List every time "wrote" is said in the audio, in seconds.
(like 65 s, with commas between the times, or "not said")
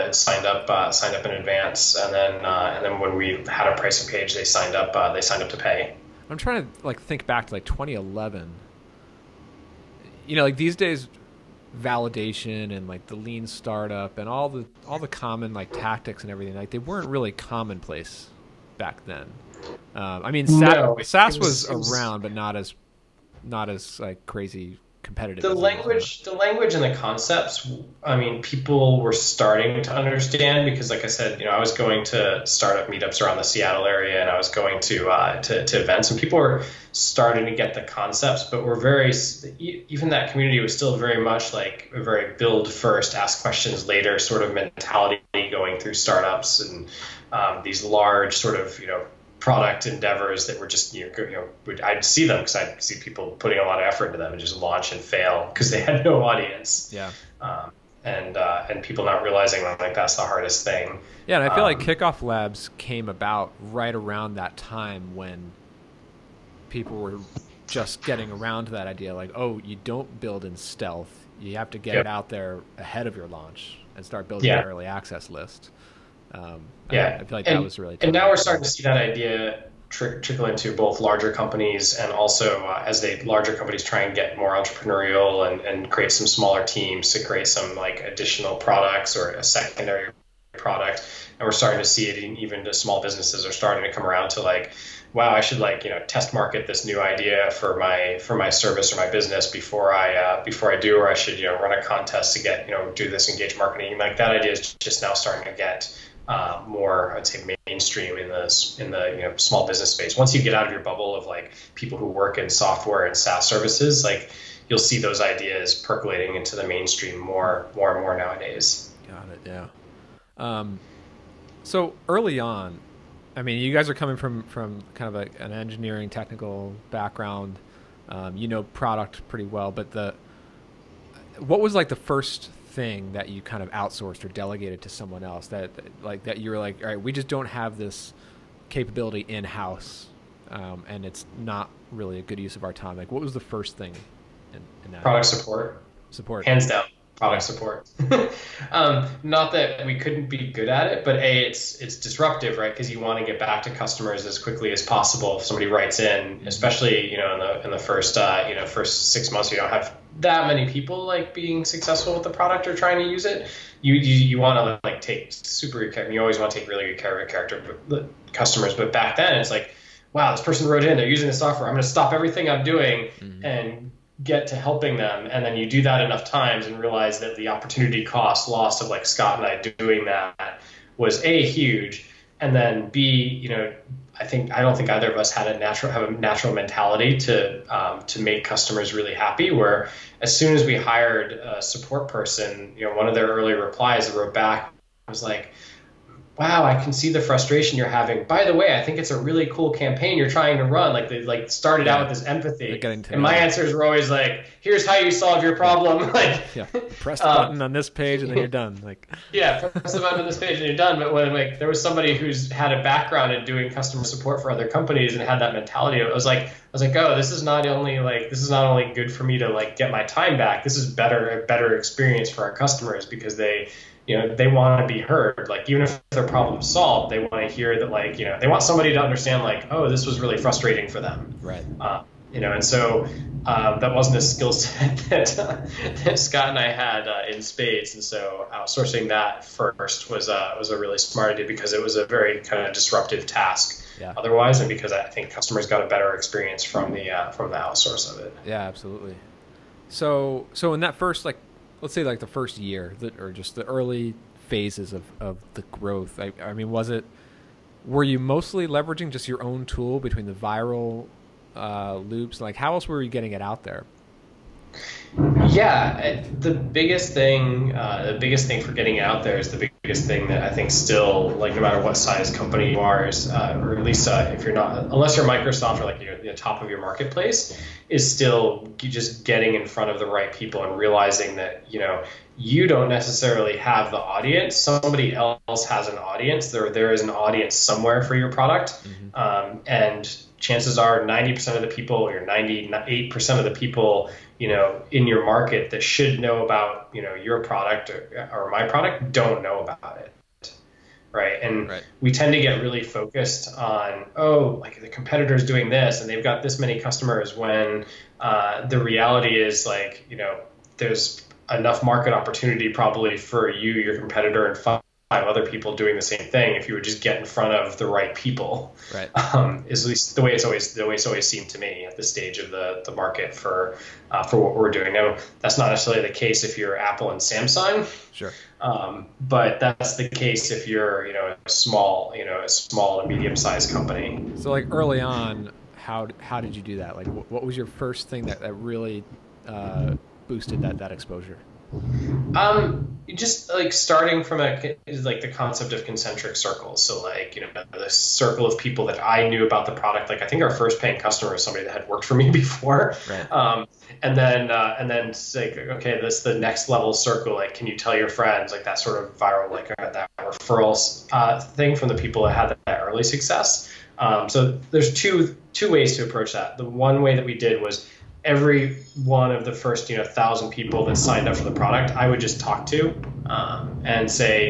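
170 s, 194 s.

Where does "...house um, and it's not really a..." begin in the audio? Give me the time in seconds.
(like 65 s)
139 s.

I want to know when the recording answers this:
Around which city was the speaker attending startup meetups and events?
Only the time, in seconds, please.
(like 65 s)
33 s.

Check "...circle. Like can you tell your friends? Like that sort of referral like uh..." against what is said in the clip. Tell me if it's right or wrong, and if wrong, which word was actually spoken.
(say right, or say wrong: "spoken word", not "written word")
wrong: "viral", not "referral".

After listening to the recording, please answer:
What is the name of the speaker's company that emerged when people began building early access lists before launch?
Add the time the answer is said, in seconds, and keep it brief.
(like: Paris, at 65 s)
Kickoff Labs, at 61 s.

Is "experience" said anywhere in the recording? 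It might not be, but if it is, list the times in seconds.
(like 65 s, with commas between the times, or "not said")
221 s, 246 s.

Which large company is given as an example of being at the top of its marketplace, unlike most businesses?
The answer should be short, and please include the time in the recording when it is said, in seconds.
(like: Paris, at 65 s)
Microsoft, at 275 s.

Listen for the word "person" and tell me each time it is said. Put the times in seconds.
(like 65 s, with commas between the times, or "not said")
170 s, 192 s.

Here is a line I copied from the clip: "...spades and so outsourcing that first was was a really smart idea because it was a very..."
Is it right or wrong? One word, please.
right.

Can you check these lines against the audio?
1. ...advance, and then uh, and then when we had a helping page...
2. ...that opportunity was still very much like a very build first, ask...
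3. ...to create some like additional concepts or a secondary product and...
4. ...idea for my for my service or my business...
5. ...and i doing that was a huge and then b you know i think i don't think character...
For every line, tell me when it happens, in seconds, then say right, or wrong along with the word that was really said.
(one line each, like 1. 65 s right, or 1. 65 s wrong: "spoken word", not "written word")
1. 1 s wrong: "pricing", not "helping"
2. 40 s wrong: "community", not "opportunity"
3. 87 s wrong: "products", not "concepts"
4. 96 s right
5. 179 s wrong: "either", not "character".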